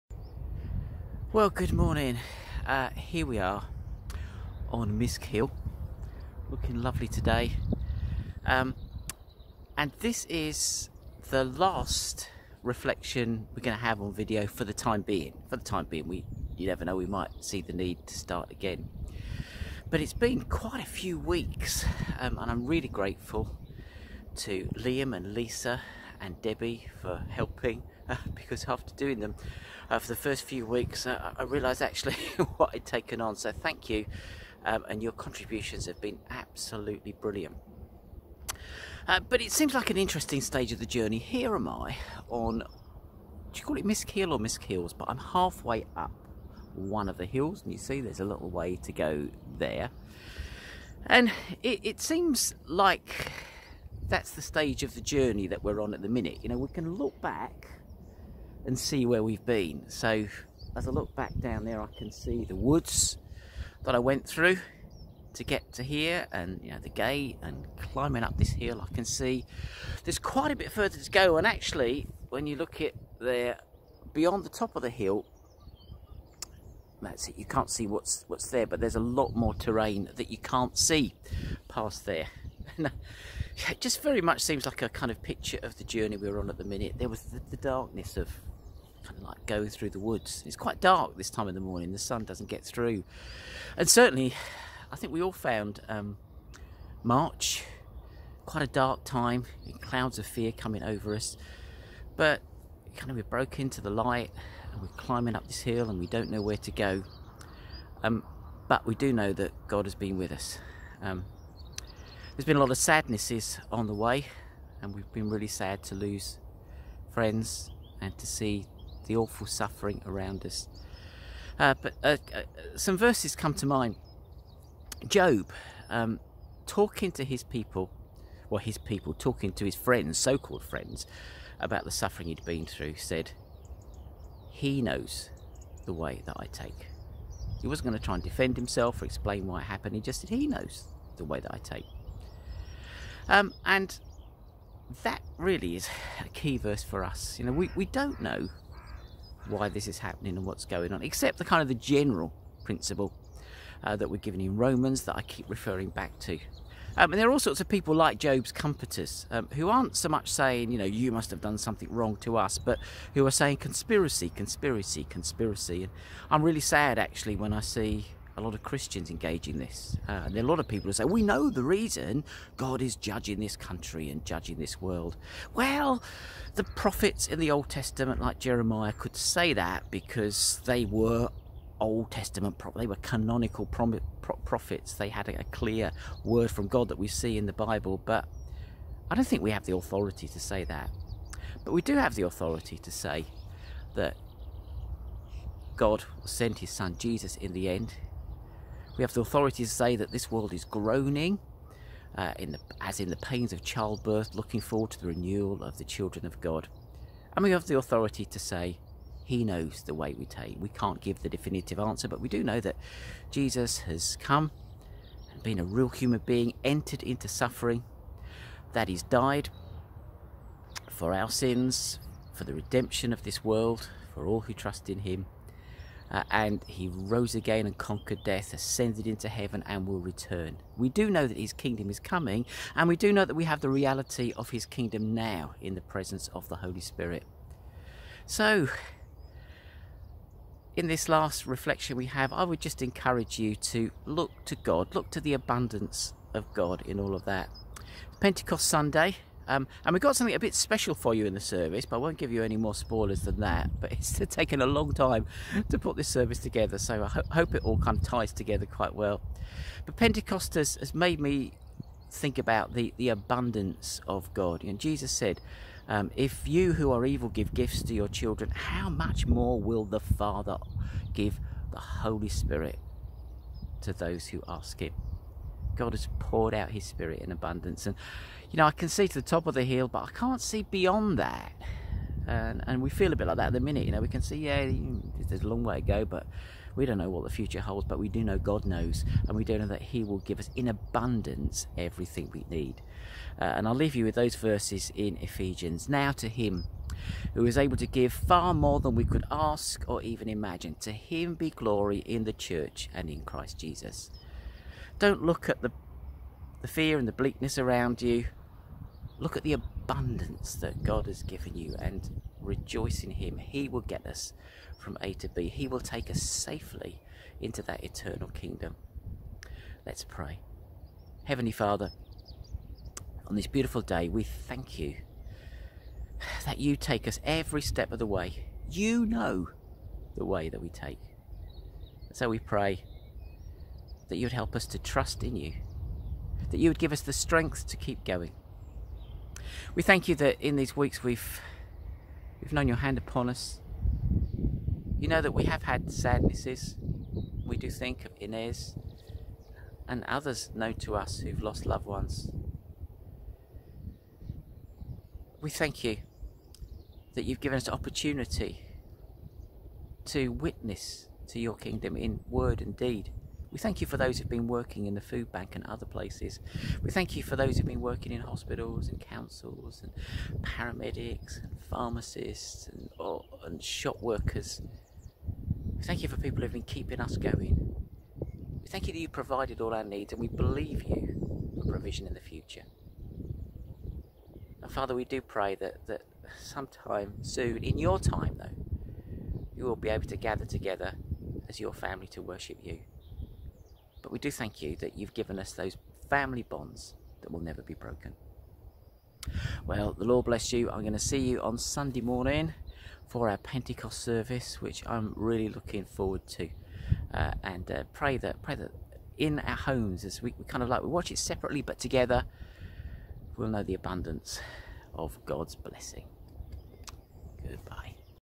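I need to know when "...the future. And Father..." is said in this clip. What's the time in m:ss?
6:22.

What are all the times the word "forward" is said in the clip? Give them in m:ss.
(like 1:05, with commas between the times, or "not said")
3:24, 6:45.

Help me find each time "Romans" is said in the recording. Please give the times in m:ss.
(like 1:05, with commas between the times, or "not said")
2:34.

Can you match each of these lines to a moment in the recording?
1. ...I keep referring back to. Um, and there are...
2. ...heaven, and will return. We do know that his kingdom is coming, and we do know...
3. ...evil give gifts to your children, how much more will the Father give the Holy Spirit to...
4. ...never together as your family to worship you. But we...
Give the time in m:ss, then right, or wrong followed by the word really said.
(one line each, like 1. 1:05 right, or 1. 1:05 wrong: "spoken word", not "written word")
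1. 2:35 right
2. 3:49 right
3. 4:27 right
4. 6:30 wrong: "gather", not "never".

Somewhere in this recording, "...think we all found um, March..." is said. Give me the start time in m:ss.
1:34.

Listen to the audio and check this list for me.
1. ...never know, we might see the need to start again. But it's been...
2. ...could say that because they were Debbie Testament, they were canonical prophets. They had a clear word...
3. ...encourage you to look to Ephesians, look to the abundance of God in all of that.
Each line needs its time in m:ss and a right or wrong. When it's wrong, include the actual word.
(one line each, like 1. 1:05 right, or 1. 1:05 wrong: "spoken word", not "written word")
1. 0:16 right
2. 2:58 wrong: "Old", not "Debbie"
3. 4:02 wrong: "God", not "Ephesians".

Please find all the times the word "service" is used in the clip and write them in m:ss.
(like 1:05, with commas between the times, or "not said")
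4:11, 4:16, 6:44.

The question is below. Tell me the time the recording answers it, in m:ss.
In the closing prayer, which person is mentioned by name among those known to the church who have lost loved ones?
5:48.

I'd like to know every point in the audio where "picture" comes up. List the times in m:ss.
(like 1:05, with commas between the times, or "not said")
1:25.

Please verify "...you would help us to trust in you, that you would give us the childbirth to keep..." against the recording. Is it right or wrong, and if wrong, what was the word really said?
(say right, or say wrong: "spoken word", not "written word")
wrong: "strength", not "childbirth".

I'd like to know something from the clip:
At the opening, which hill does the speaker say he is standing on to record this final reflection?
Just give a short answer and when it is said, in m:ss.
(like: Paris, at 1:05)
Misk Hill, at 0:04.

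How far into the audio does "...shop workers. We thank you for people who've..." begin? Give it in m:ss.
6:13.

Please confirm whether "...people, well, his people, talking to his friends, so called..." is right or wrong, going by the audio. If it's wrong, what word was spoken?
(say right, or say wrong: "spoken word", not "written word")
right.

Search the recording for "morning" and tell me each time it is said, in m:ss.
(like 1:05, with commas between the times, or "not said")
0:01, 1:31, 6:42.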